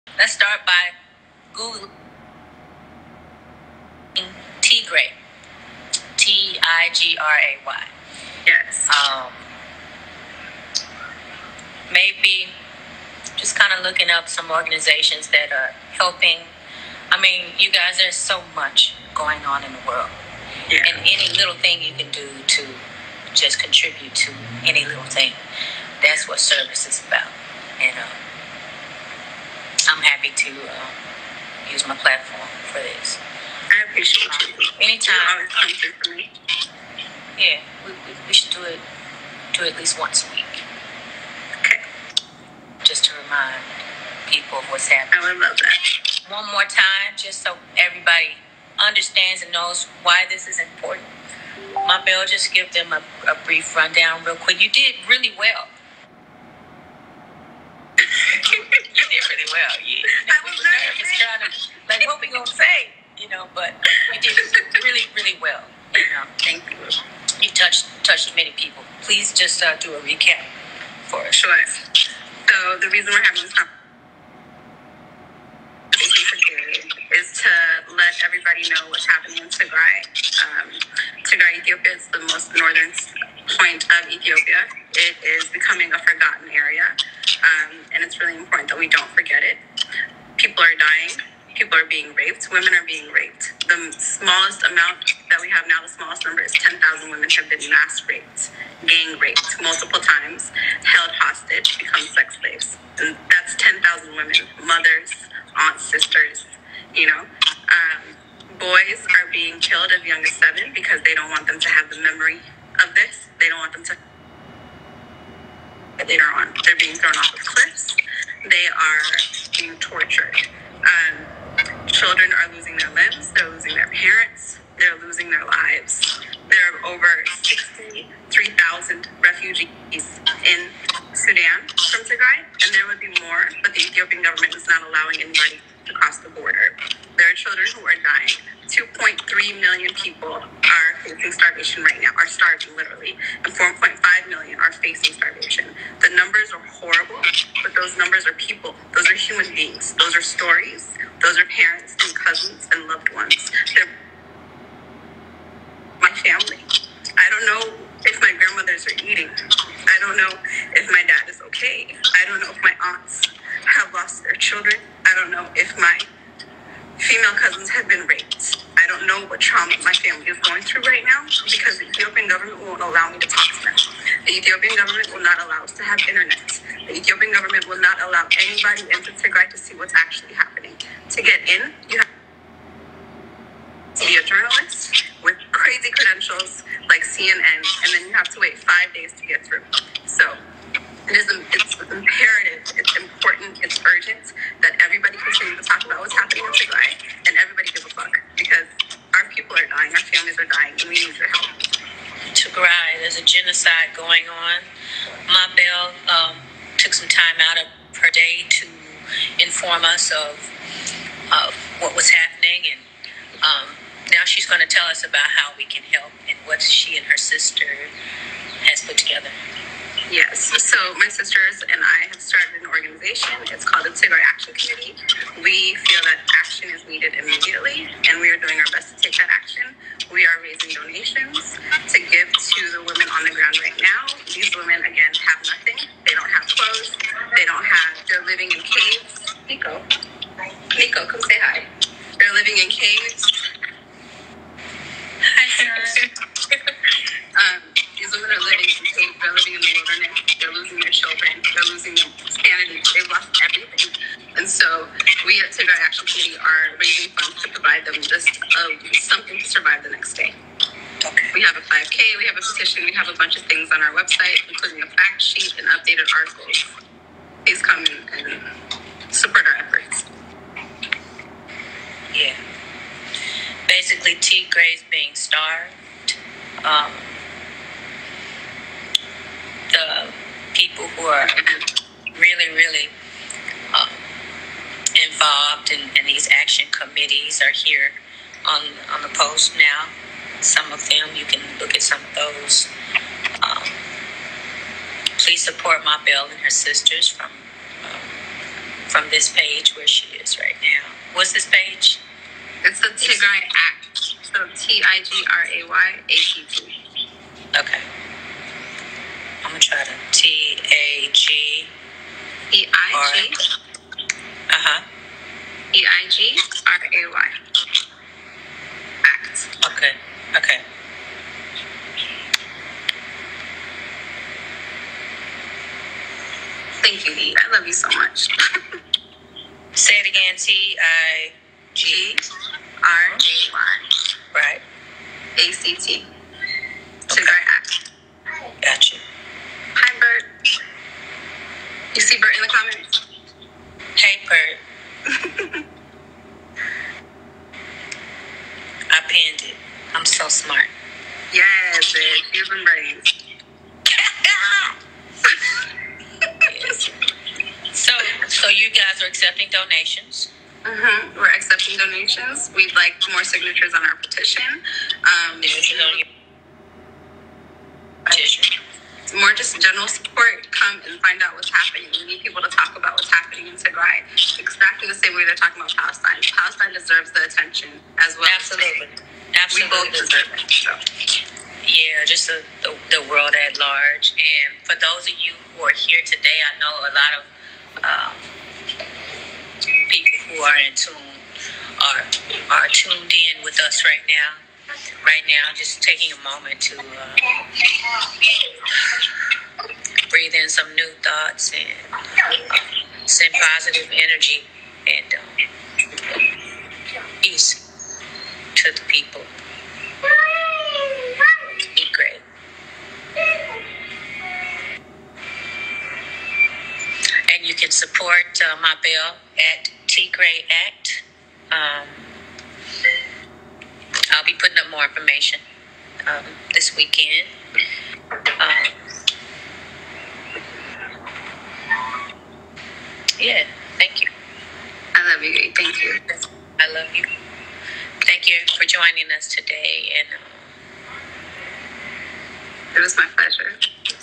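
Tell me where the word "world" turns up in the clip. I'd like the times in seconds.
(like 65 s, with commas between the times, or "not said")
19 s, 383 s.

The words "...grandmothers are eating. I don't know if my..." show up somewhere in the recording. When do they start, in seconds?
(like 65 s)
158 s.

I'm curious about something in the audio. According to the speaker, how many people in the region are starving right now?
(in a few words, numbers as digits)
2.3 million.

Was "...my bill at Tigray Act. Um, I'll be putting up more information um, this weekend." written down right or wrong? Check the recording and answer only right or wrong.
right.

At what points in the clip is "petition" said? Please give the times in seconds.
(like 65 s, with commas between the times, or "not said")
262 s, 363 s.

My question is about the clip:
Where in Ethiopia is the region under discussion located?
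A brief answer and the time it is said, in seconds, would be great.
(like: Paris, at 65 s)
Most northern point, at 82 s.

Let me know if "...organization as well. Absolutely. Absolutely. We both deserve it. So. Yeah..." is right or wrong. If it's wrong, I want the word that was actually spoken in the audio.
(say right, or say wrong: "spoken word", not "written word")
wrong: "attention", not "organization".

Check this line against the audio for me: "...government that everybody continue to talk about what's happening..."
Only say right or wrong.
wrong.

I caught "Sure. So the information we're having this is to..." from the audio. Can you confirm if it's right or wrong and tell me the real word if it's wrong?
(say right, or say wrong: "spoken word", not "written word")
wrong: "reason", not "information".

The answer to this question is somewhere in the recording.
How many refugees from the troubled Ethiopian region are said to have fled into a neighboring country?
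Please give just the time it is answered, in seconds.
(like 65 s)
127 s.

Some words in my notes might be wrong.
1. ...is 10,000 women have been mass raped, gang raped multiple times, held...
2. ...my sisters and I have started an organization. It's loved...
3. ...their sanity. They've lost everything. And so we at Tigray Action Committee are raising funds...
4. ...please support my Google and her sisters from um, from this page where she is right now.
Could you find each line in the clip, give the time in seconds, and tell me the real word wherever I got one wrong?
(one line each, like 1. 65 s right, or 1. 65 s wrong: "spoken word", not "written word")
1. 96 s right
2. 220 s wrong: "called", not "loved"
3. 251 s right
4. 295 s wrong: "Belle", not "Google".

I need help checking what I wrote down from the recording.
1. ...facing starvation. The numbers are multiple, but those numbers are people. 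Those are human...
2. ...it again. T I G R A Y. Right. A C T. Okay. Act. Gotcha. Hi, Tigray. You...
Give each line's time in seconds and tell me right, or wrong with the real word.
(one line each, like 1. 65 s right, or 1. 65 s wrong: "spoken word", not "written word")
1. 144 s wrong: "horrible", not "multiple"
2. 329 s wrong: "Bert", not "Tigray".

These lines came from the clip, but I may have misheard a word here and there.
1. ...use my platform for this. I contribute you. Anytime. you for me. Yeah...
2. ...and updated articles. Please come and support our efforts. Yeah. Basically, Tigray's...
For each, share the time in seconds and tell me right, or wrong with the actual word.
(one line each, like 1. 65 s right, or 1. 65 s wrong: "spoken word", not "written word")
1. 31 s wrong: "appreciate", not "contribute"
2. 265 s right.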